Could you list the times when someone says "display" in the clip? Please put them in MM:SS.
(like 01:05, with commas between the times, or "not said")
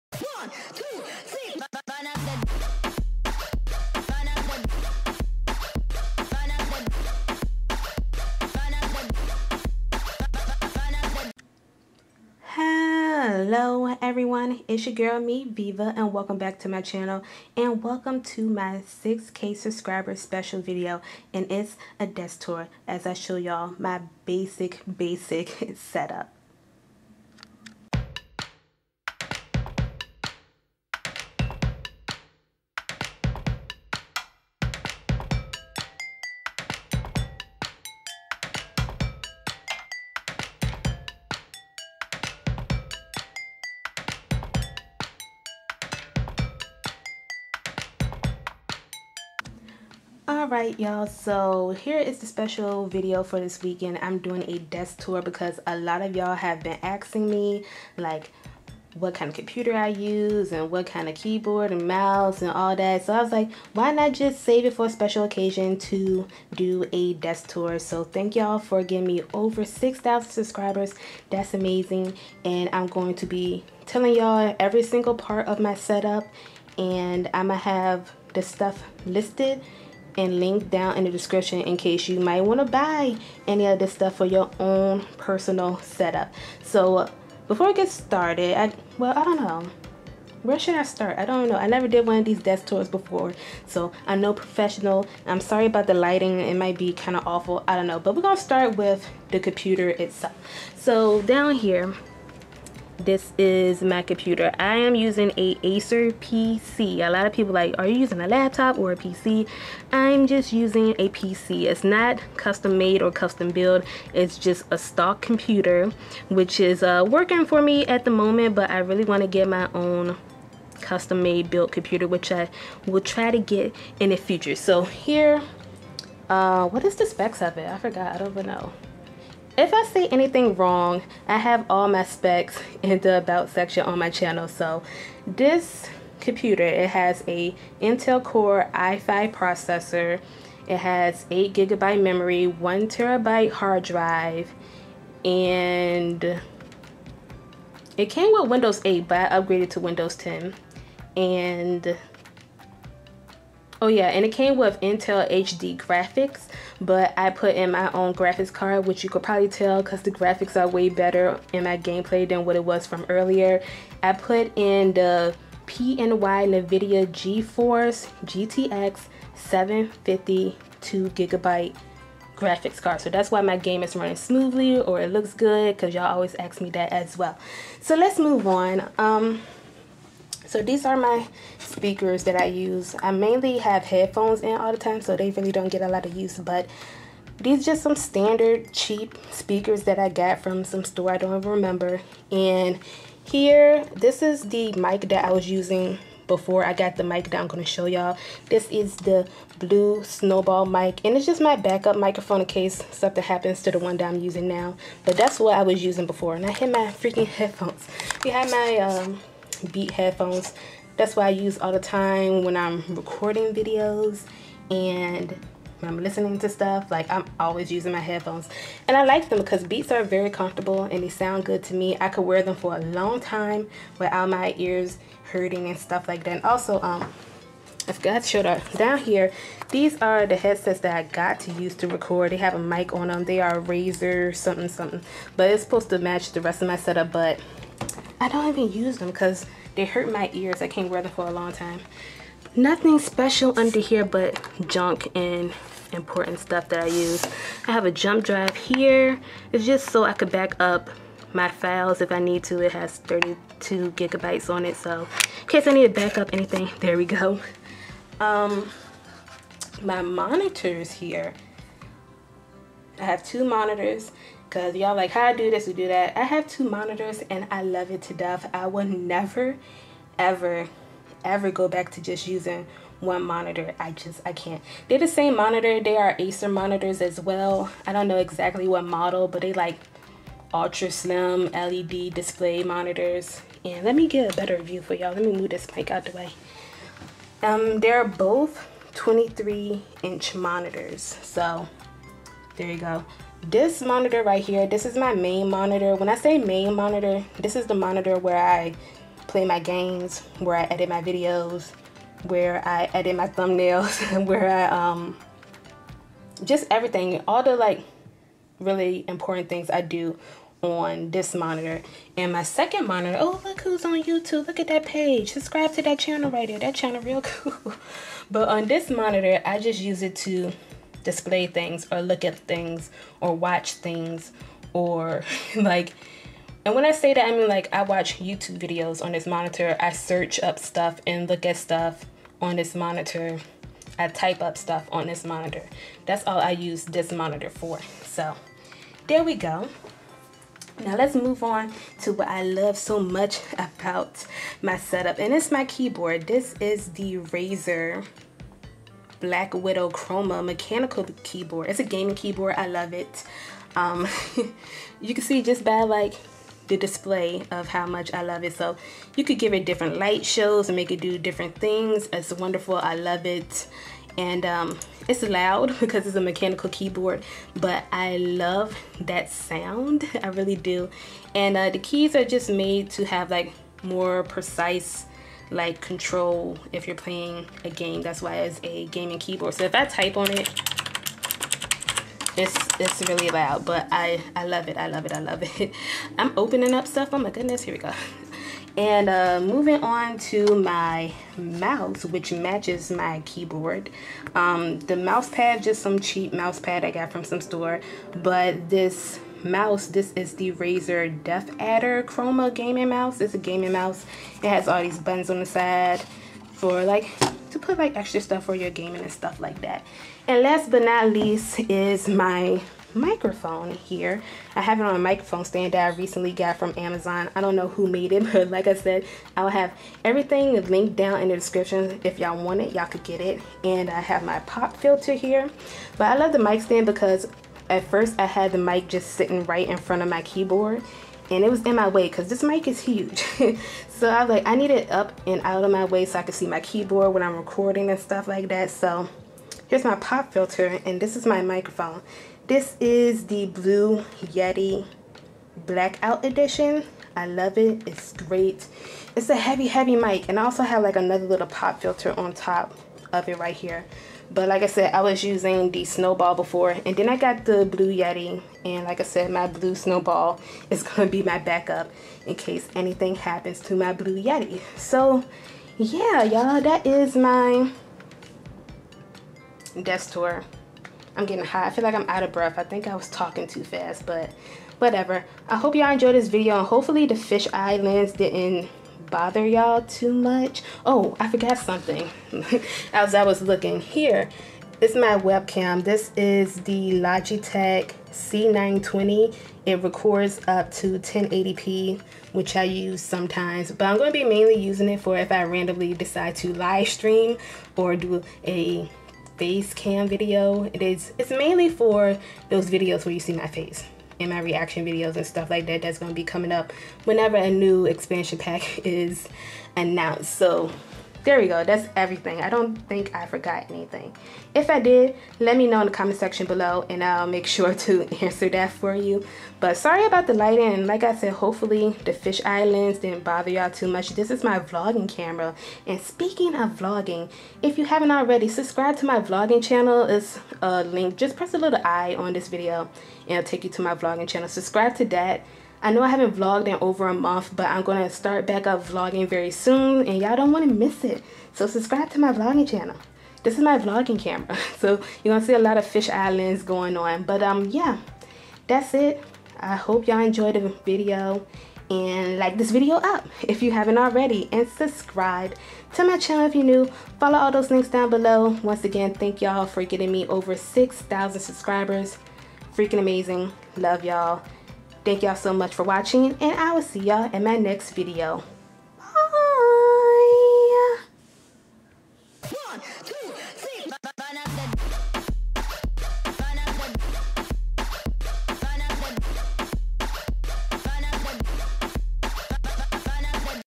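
04:42, 05:21, 05:56.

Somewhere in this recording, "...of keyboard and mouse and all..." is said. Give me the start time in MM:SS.
01:01.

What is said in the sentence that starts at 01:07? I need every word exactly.
So thank y'all for giving me over 6,000 subscribers.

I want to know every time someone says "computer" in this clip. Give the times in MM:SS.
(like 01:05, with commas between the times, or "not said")
00:59, 01:39, 01:44, 01:55, 02:01, 02:16.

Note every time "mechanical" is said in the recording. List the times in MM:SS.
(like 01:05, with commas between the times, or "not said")
05:50, 06:06.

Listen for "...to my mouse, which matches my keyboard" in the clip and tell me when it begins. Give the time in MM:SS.
06:30.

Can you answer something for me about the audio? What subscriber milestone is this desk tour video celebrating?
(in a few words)
6k.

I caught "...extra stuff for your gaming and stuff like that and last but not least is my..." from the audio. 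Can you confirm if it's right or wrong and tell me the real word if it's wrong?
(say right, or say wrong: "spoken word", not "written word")
right.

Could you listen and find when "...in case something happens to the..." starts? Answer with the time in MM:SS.
03:22.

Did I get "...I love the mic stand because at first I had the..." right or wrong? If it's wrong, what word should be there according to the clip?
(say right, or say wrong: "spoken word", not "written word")
right.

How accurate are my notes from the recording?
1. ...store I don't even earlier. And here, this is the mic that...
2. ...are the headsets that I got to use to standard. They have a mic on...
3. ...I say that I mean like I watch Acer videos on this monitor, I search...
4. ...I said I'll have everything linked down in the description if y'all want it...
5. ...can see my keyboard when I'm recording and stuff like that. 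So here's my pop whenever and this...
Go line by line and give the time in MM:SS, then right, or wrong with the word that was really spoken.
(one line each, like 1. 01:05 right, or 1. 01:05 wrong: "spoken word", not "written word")
1. 03:10 wrong: "remember", not "earlier"
2. 03:50 wrong: "record", not "standard"
3. 05:26 wrong: "YouTube", not "Acer"
4. 06:58 right
5. 07:16 wrong: "filter", not "whenever".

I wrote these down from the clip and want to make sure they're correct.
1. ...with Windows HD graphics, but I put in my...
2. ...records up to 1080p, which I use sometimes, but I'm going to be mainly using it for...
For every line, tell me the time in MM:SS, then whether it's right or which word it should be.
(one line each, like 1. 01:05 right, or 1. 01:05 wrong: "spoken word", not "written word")
1. 02:34 wrong: "Intel", not "Windows"
2. 08:09 right.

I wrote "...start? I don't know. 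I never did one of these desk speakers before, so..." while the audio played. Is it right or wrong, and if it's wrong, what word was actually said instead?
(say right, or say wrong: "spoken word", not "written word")
wrong: "tours", not "speakers".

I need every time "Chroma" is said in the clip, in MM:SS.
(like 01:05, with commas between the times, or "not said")
05:49, 06:42.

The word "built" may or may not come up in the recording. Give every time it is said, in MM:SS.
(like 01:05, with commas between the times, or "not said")
01:53, 02:01.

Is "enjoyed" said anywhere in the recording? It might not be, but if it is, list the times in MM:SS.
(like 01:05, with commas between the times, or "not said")
07:55, 09:10.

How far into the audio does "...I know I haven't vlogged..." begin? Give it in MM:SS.
08:55.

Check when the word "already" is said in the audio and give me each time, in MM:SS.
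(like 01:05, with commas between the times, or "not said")
08:48, 09:13.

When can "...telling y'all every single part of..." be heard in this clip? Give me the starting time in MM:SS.
01:13.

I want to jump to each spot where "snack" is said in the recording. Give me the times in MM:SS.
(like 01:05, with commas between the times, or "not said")
not said.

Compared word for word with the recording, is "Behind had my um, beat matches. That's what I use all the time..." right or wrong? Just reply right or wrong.
wrong.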